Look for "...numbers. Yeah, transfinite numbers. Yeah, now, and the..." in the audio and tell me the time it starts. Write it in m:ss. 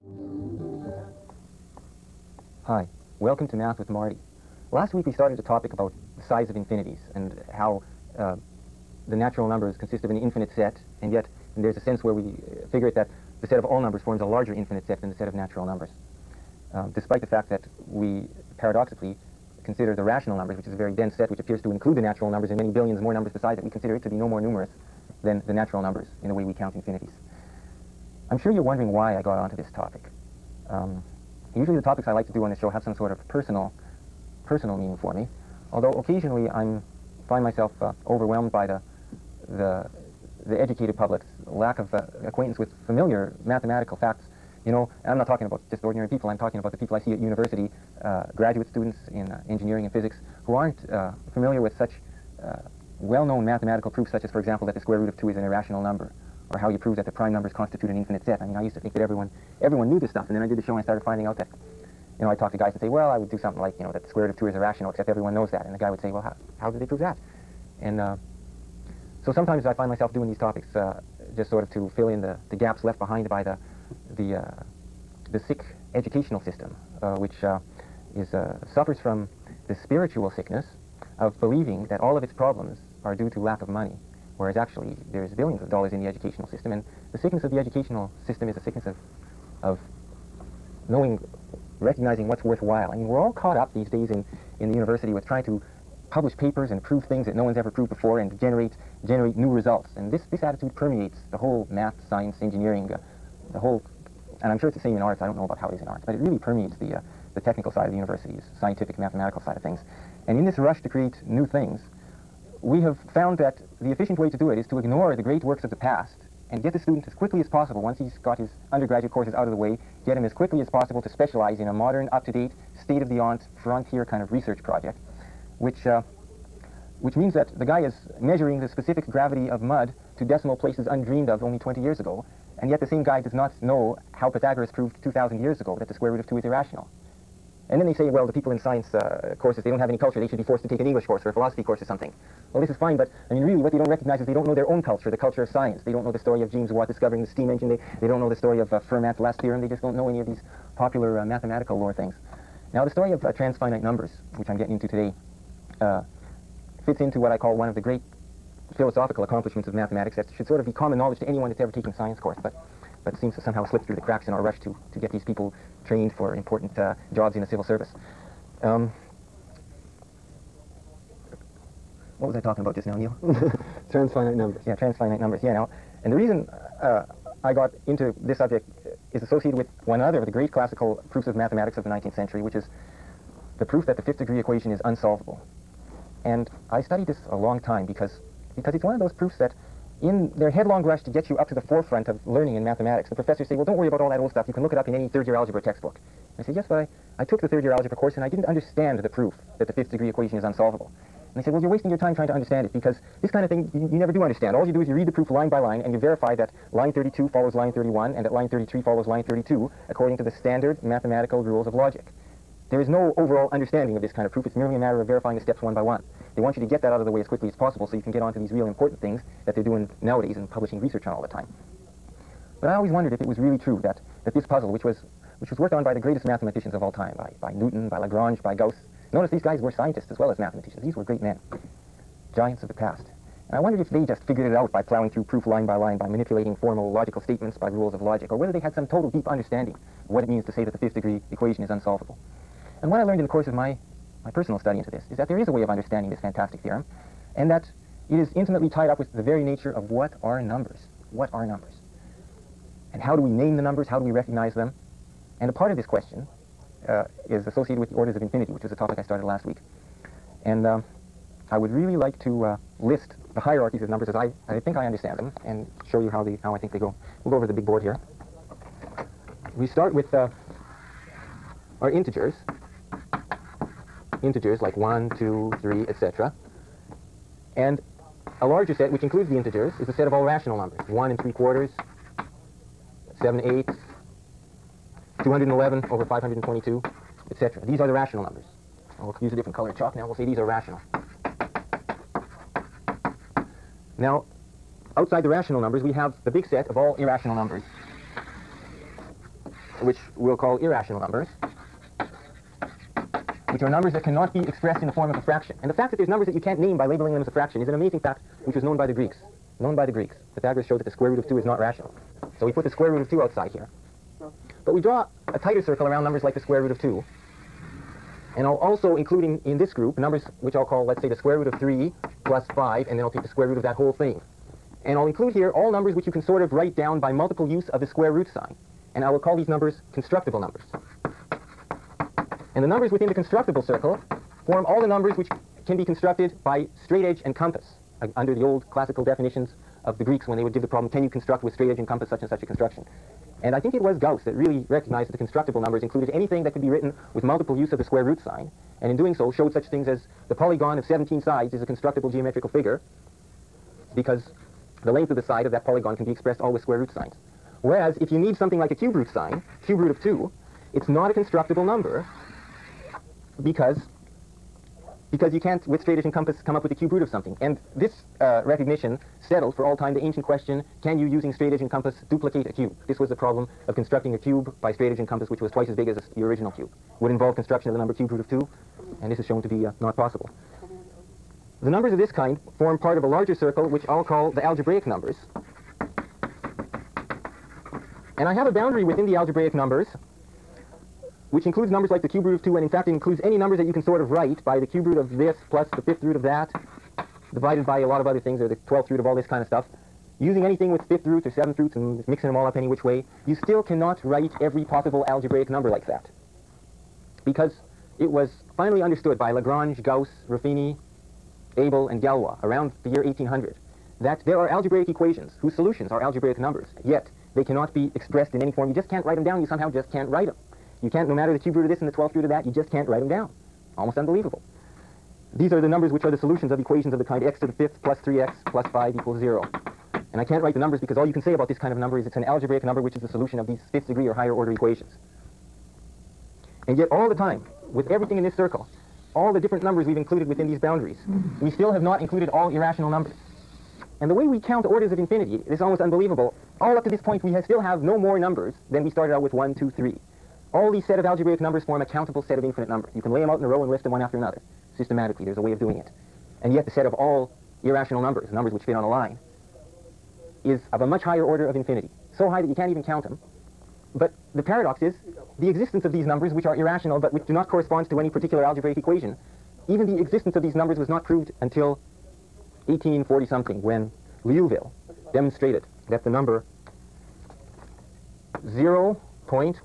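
2:54.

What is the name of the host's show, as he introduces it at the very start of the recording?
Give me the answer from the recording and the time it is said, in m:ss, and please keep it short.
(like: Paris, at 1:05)
Math with Marty, at 0:03.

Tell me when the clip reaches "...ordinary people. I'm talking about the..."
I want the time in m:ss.
0:45.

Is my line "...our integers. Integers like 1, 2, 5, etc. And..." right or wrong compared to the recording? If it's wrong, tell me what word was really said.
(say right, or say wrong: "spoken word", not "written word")
wrong: "3", not "5".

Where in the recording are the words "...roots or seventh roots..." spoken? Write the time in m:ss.
6:41.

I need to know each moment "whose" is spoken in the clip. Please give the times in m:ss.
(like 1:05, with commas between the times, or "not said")
6:55.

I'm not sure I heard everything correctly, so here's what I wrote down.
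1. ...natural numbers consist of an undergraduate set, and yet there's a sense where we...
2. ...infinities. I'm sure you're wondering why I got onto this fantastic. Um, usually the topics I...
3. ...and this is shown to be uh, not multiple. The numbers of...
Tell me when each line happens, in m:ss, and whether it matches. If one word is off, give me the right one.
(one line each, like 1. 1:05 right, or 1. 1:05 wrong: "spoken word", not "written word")
1. 0:09 wrong: "infinite", not "undergraduate"
2. 0:26 wrong: "topic", not "fantastic"
3. 6:19 wrong: "possible", not "multiple".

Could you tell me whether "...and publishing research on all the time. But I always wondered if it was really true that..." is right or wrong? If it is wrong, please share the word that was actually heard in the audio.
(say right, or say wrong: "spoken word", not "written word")
right.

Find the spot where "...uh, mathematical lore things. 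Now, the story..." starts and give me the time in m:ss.
2:31.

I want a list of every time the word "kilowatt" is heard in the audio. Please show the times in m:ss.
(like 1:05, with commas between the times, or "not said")
not said.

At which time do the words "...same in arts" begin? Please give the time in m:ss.
1:44.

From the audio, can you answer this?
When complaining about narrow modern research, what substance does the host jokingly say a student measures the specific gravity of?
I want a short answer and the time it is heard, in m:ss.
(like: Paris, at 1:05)
mud, at 2:09.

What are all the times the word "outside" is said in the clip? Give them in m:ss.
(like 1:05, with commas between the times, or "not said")
4:54, 5:13.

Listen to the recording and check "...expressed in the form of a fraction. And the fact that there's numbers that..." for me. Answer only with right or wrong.
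right.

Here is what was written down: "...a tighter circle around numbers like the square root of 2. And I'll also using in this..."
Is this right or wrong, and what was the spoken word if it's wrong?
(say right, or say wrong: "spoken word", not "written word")
wrong: "including", not "using".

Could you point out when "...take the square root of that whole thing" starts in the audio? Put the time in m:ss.
5:23.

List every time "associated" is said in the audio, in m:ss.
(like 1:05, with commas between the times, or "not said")
2:59, 4:17.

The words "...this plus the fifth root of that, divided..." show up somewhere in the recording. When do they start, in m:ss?
6:35.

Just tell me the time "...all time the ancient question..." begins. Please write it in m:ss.
6:09.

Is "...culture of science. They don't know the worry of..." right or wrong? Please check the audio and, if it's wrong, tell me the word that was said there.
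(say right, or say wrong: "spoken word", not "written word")
wrong: "story", not "worry".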